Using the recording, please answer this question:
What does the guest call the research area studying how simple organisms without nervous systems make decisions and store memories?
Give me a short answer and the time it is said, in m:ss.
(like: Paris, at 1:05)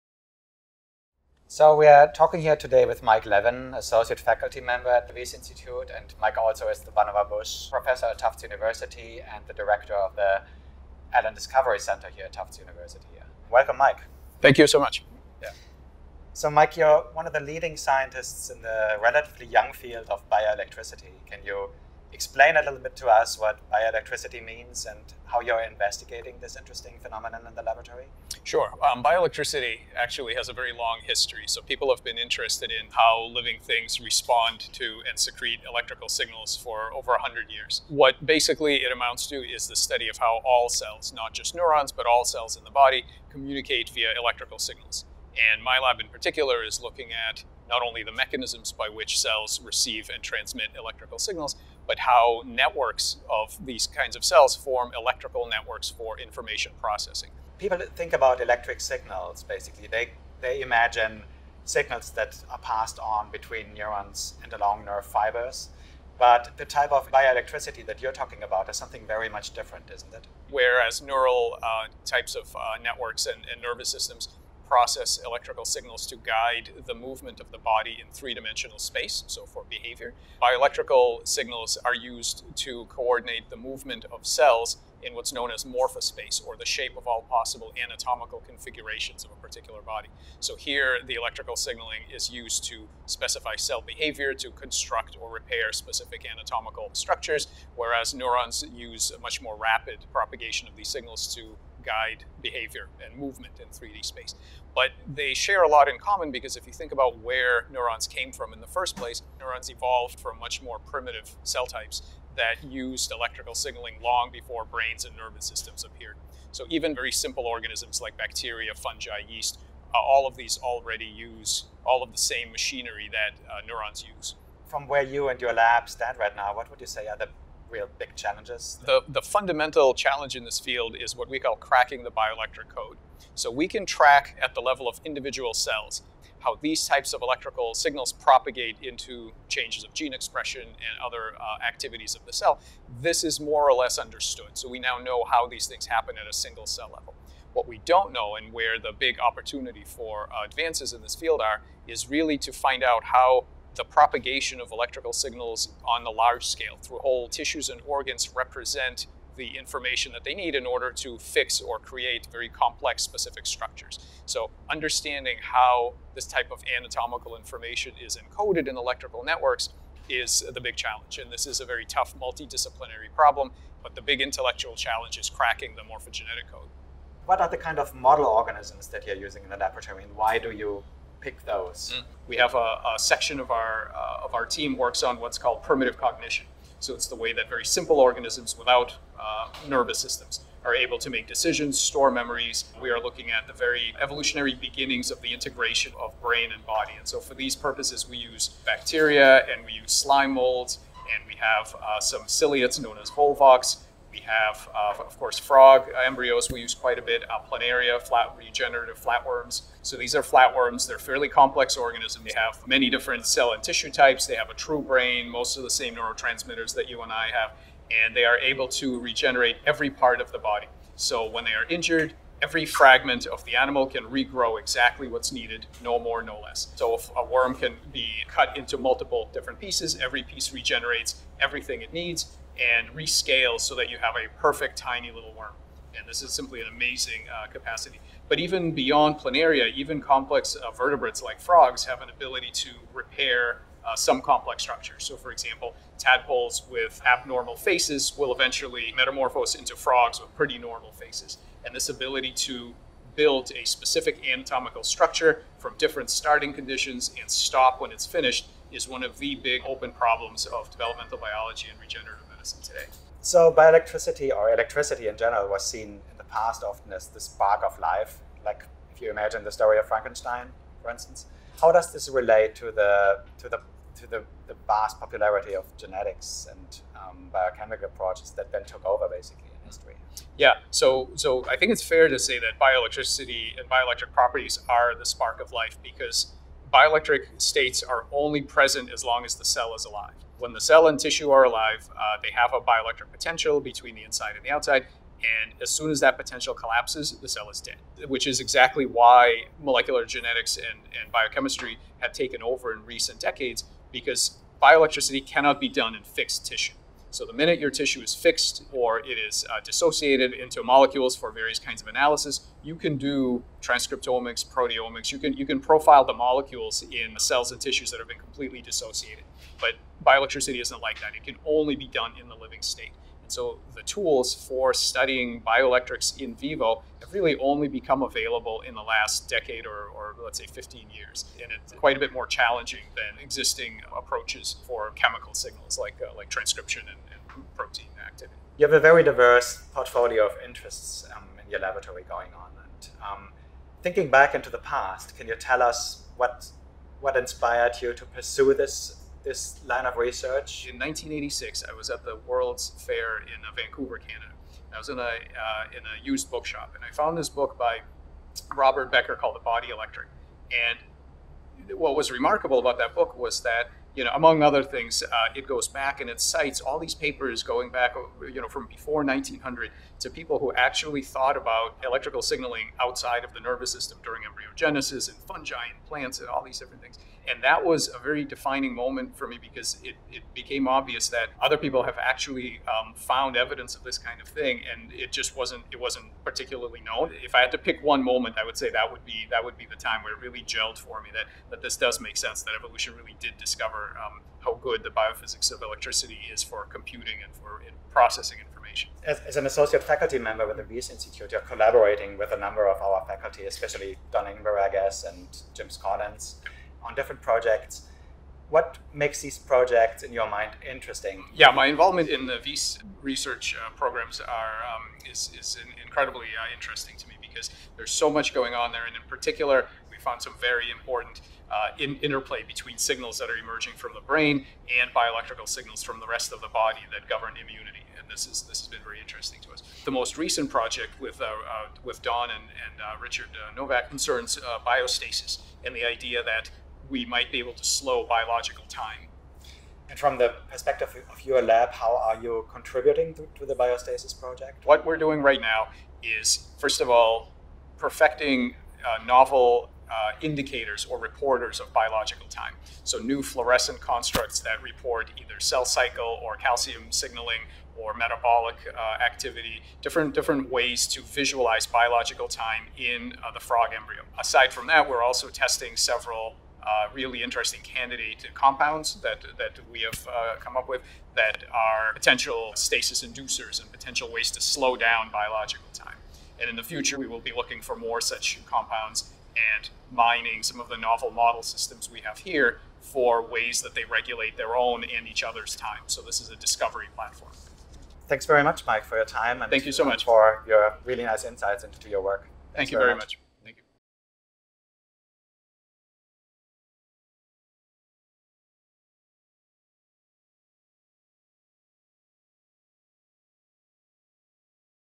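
primitive cognition, at 3:05.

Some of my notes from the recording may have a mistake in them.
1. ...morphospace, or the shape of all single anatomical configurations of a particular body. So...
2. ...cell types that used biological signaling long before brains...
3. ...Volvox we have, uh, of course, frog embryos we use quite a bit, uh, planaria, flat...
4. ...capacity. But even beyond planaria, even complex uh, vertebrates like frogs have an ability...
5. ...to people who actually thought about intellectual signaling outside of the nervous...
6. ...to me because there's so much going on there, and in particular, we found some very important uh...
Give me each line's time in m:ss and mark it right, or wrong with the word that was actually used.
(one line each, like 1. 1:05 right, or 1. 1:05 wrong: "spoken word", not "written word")
1. 1:25 wrong: "possible", not "single"
2. 1:51 wrong: "electrical", not "biological"
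3. 3:23 right
4. 3:57 right
5. 6:09 wrong: "electrical", not "intellectual"
6. 6:56 right.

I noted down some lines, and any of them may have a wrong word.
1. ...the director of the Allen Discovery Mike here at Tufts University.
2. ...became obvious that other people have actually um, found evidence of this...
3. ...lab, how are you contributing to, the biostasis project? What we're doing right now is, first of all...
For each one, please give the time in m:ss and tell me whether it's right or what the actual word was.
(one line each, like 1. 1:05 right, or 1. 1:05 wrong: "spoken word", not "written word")
1. 0:09 wrong: "Center", not "Mike"
2. 6:20 right
3. 7:21 right.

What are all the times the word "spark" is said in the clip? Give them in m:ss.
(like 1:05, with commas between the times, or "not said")
4:27, 4:45.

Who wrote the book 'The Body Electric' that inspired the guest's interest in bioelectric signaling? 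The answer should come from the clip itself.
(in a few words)
Robert Becker.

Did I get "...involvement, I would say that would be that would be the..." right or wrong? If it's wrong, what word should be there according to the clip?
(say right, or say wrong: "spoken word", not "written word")
wrong: "moment", not "involvement".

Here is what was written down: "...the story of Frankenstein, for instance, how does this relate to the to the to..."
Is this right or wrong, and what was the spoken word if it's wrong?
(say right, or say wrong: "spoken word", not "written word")
right.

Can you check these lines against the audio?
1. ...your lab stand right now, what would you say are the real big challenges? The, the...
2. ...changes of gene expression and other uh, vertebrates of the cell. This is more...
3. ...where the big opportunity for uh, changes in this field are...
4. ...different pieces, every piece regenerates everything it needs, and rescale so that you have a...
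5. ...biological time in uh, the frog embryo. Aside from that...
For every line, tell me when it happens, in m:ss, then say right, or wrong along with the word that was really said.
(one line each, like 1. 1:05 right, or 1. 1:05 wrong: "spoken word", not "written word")
1. 2:05 right
2. 2:19 wrong: "activities", not "vertebrates"
3. 2:28 wrong: "advances", not "changes"
4. 3:49 right
5. 7:41 right.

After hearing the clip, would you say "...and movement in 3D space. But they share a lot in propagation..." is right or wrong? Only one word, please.
wrong.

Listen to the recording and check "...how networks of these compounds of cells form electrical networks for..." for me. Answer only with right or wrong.
wrong.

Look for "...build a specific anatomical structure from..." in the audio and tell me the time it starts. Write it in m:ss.
4:13.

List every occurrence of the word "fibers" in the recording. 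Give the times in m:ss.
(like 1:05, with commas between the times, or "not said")
1:05.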